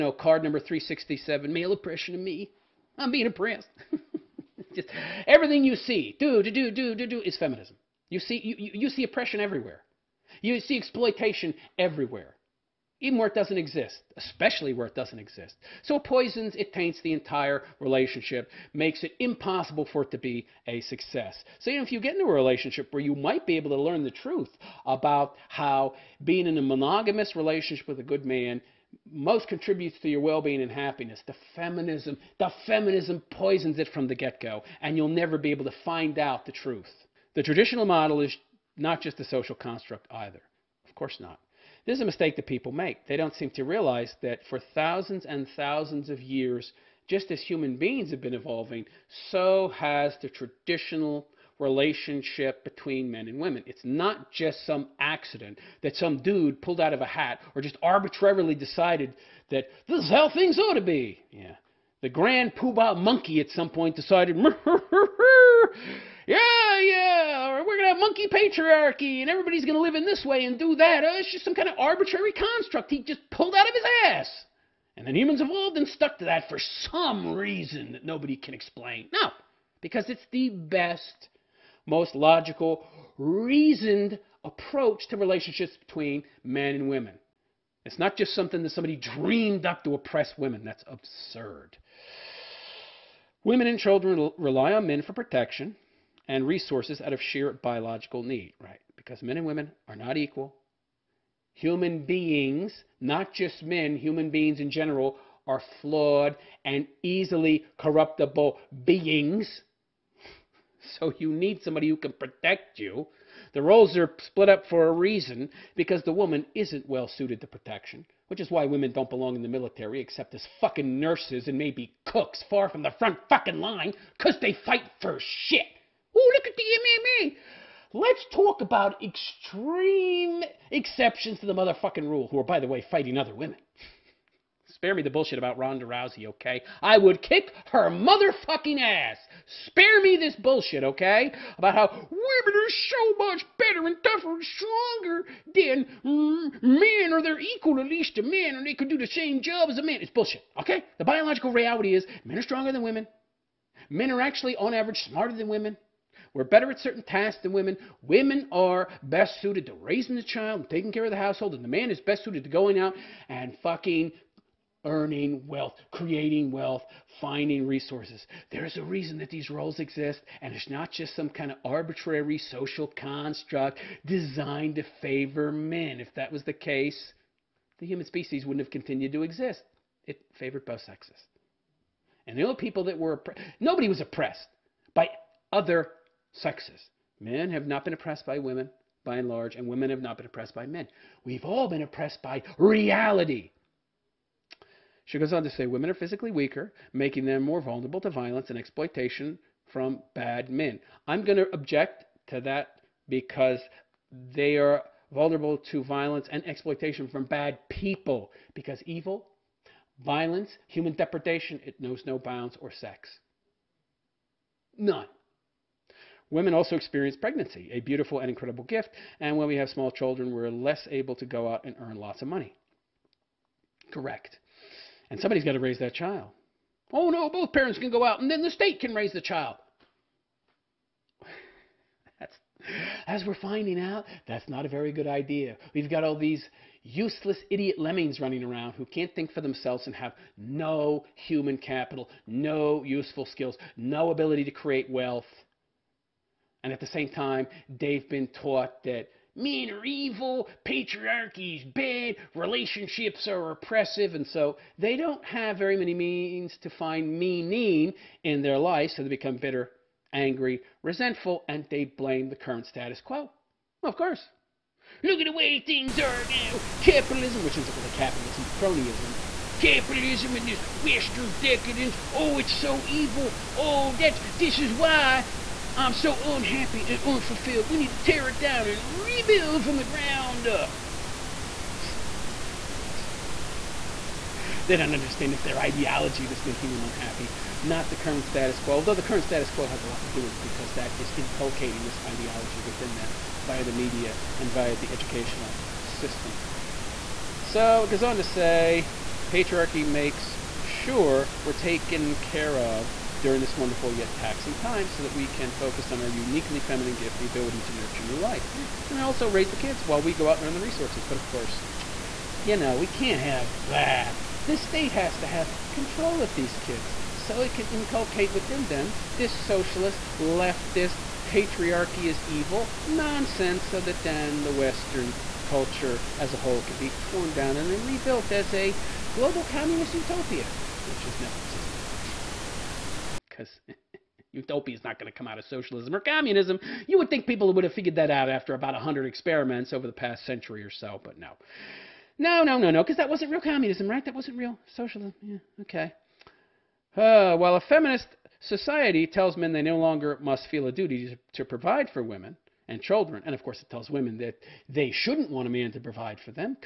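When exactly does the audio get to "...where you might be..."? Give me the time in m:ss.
0:22.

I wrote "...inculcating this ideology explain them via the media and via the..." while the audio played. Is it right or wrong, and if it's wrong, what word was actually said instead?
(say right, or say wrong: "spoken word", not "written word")
wrong: "within", not "explain".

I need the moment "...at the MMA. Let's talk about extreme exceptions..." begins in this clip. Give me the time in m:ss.
2:06.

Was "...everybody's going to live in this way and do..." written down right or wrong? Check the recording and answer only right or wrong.
right.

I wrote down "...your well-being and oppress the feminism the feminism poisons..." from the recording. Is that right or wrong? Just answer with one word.
wrong.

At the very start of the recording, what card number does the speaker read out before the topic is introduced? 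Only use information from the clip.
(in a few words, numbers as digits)
367.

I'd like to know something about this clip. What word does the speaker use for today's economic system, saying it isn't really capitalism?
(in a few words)
cronyism.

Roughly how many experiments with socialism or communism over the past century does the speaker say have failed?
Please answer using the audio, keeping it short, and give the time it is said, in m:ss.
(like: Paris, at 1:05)
about 100, at 5:38.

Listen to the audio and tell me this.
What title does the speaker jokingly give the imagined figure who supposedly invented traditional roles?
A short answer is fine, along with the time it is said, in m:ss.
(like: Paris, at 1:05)
grand poobah monkey, at 1:02.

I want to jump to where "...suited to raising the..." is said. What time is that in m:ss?
2:39.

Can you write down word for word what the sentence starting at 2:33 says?
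Men are actually, on average, smarter than women.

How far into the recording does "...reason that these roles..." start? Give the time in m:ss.
2:48.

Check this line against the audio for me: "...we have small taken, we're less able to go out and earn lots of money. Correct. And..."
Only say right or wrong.
wrong.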